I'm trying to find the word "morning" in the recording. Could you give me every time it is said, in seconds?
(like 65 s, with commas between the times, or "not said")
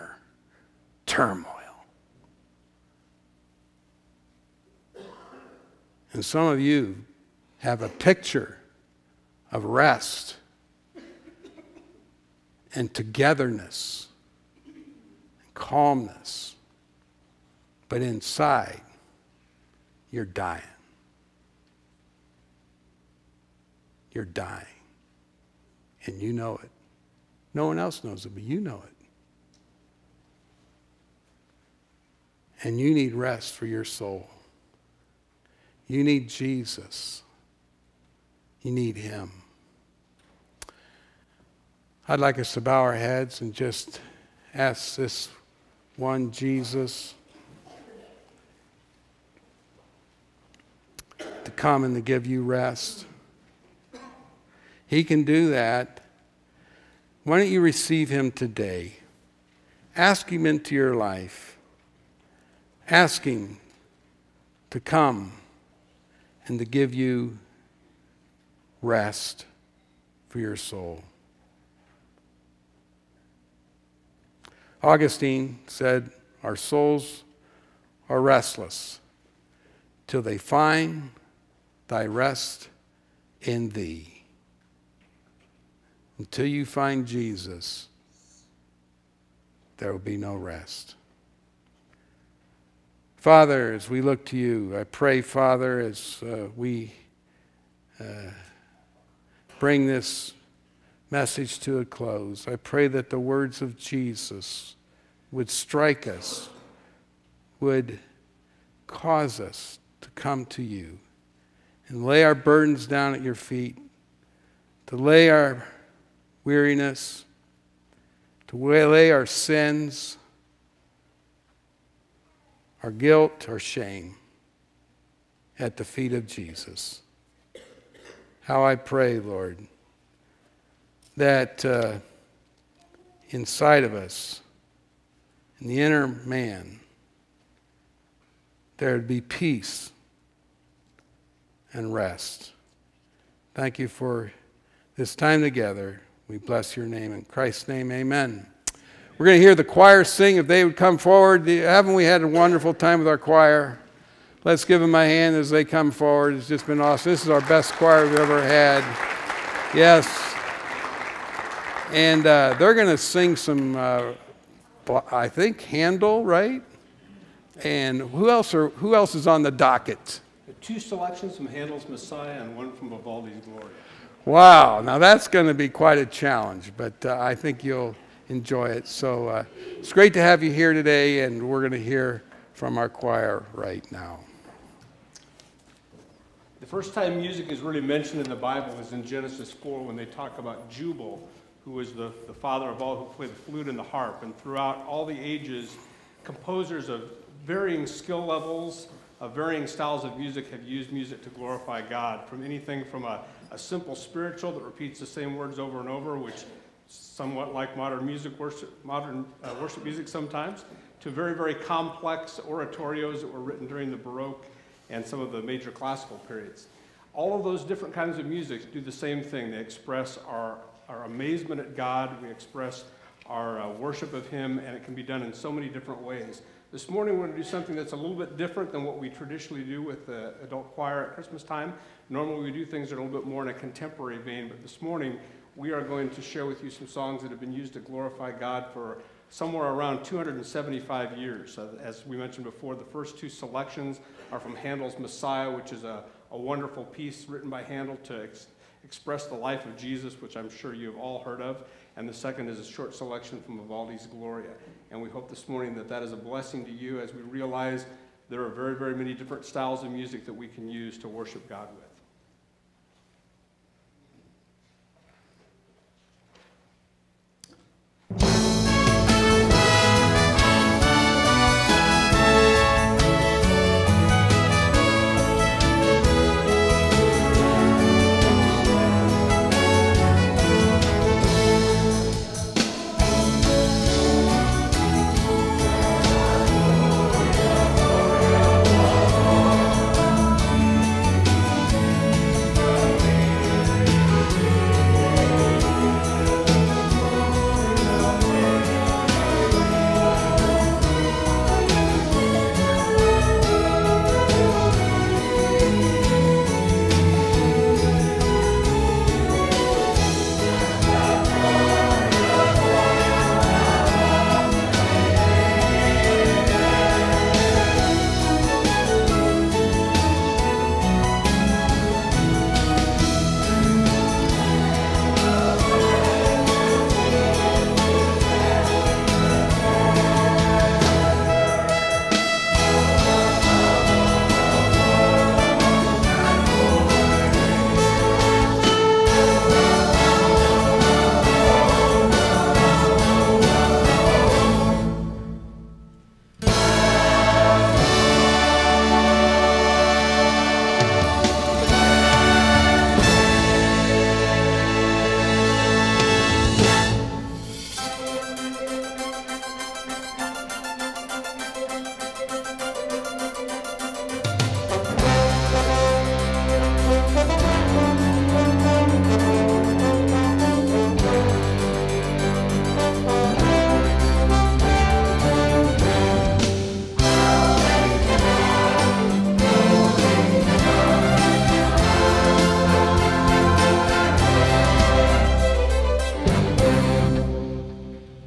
226 s, 234 s, 255 s.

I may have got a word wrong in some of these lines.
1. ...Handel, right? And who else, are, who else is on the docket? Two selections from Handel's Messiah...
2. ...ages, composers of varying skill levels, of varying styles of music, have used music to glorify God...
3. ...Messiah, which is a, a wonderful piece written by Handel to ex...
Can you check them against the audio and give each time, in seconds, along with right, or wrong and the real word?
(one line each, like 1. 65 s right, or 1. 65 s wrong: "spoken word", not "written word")
1. 165 s right
2. 195 s right
3. 244 s right.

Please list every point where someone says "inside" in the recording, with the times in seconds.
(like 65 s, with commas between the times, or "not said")
18 s, 133 s.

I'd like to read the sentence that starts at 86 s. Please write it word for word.
Until you find Jesus, there will be no rest.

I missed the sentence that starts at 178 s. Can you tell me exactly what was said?
So uh, it's great to have you here today, and we're going to hear from our choir right now.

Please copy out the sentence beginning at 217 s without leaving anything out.
All of those different kinds of music do the same thing.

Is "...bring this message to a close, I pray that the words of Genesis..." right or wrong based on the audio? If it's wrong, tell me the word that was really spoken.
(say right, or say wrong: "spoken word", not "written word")
wrong: "Jesus", not "Genesis".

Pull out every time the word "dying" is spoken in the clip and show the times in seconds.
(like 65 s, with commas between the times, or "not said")
20 s, 24 s.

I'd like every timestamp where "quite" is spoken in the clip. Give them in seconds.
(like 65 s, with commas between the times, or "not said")
175 s.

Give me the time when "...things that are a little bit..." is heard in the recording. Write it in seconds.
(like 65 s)
232 s.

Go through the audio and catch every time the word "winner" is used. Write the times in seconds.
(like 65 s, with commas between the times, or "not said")
not said.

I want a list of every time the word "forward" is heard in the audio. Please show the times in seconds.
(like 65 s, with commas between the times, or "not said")
150 s, 155 s.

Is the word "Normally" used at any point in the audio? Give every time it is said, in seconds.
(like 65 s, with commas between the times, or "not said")
232 s.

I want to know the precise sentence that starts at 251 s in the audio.
And the second is a short selection from Vivaldi's Gloria.